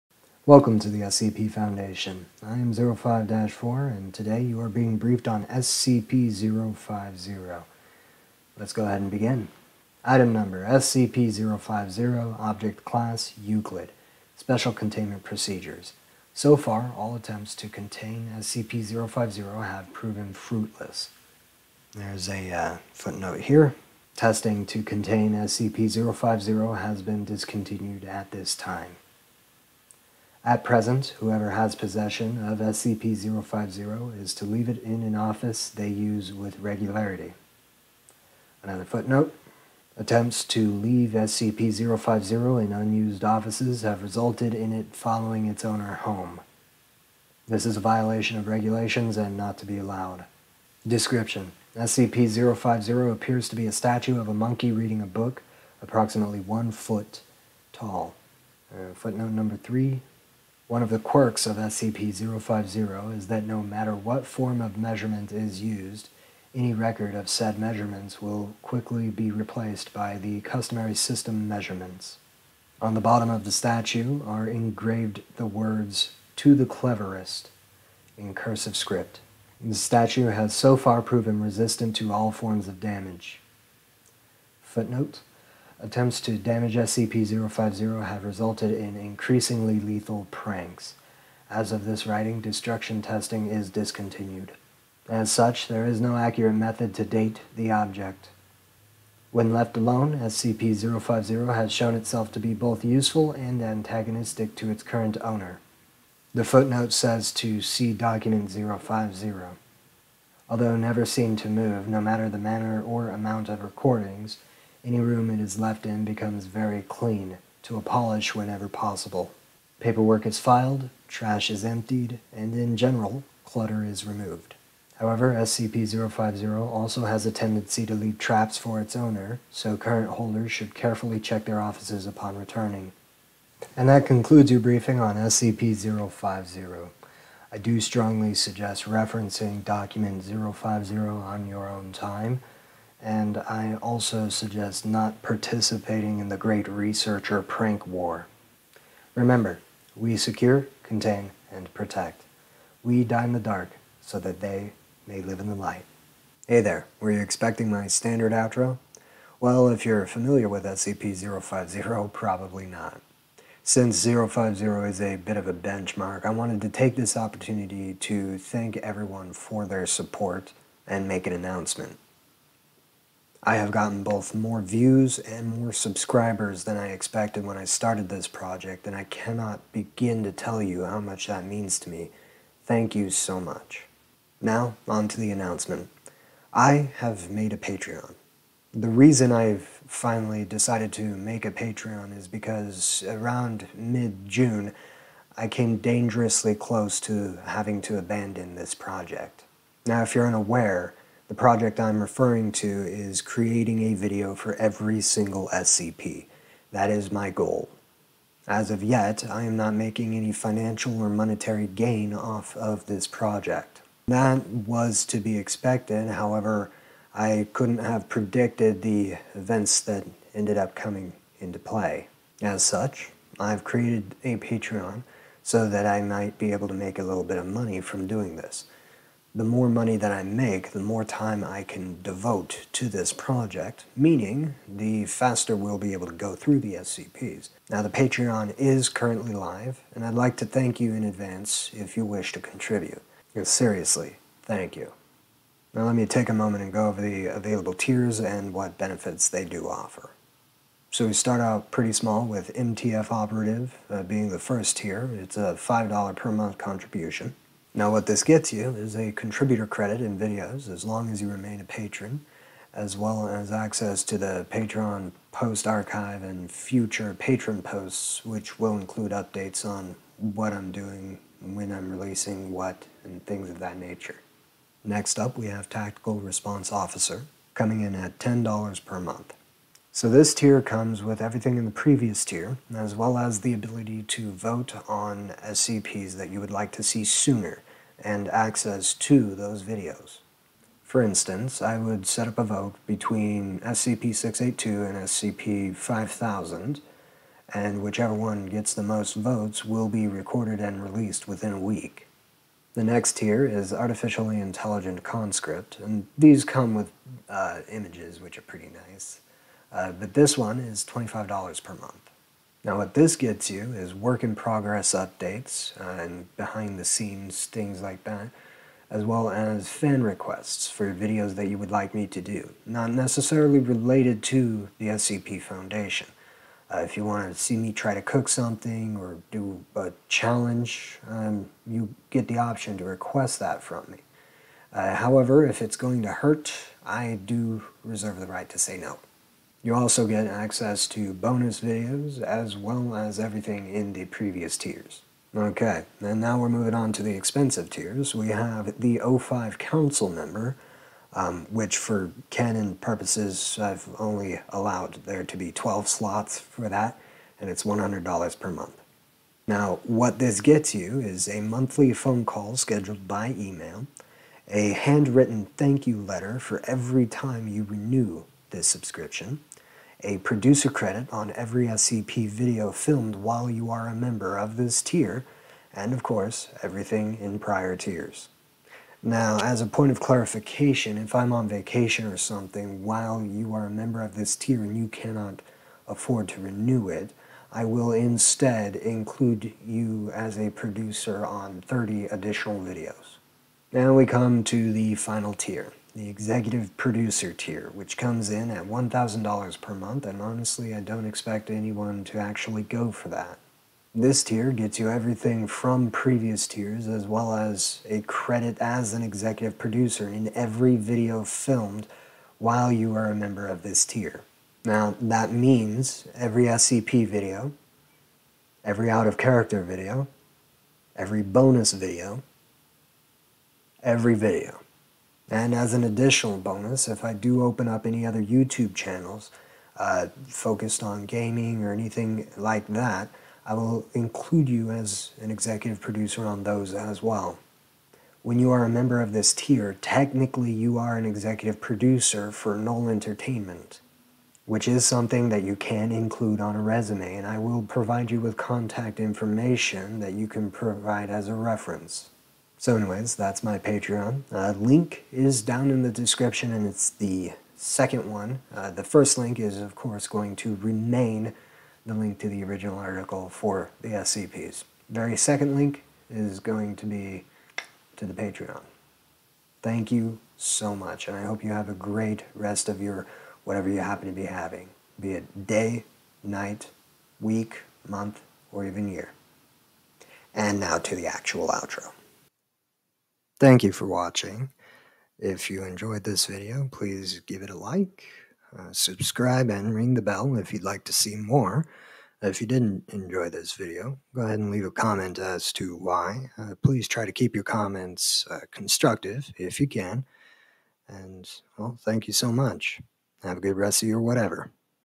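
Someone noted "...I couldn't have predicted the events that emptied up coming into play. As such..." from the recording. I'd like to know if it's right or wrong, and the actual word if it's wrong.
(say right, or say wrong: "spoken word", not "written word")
wrong: "ended", not "emptied".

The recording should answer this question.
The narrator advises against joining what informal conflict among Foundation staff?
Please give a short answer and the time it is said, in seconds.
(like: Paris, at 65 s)
The great researcher prank war, at 146 s.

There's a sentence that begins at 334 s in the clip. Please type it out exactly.
Uh, however, if it's going to hurt, I do reserve the right to say no.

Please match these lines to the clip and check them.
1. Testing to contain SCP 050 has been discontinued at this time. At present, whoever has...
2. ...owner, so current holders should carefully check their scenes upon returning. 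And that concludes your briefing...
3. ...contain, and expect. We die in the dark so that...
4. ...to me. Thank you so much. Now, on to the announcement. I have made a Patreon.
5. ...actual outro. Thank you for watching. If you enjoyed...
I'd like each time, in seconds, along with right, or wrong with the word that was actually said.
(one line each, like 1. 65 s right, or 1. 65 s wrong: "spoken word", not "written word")
1. 24 s right
2. 128 s wrong: "offices", not "scenes"
3. 150 s wrong: "protect", not "expect"
4. 181 s right
5. 481 s right.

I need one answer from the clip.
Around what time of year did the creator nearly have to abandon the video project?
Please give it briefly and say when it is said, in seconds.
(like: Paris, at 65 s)
Mid June, at 193 s.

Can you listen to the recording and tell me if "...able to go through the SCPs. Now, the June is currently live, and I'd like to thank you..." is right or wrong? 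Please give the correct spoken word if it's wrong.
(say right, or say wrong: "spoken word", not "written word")
wrong: "Patreon", not "June".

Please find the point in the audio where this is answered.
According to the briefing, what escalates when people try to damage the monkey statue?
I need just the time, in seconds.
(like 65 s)
88 s.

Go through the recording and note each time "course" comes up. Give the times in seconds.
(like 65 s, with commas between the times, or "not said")
376 s, 459 s.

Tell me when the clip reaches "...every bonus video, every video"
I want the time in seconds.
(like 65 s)
420 s.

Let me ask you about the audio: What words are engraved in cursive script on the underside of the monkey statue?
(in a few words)
To the Cleverest.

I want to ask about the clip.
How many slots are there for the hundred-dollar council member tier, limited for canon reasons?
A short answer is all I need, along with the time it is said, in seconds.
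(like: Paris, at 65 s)
12, at 355 s.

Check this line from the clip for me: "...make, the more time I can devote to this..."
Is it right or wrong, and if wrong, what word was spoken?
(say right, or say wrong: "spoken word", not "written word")
right.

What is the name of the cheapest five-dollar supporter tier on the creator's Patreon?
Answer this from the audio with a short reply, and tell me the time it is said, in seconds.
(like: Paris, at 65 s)
MTF Operative, at 252 s.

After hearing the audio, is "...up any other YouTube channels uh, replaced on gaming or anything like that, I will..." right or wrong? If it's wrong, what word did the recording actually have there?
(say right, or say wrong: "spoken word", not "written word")
wrong: "focused", not "replaced".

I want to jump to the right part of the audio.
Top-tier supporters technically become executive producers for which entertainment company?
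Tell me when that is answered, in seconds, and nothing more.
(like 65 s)
442 s.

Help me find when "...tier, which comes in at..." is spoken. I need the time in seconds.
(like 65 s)
397 s.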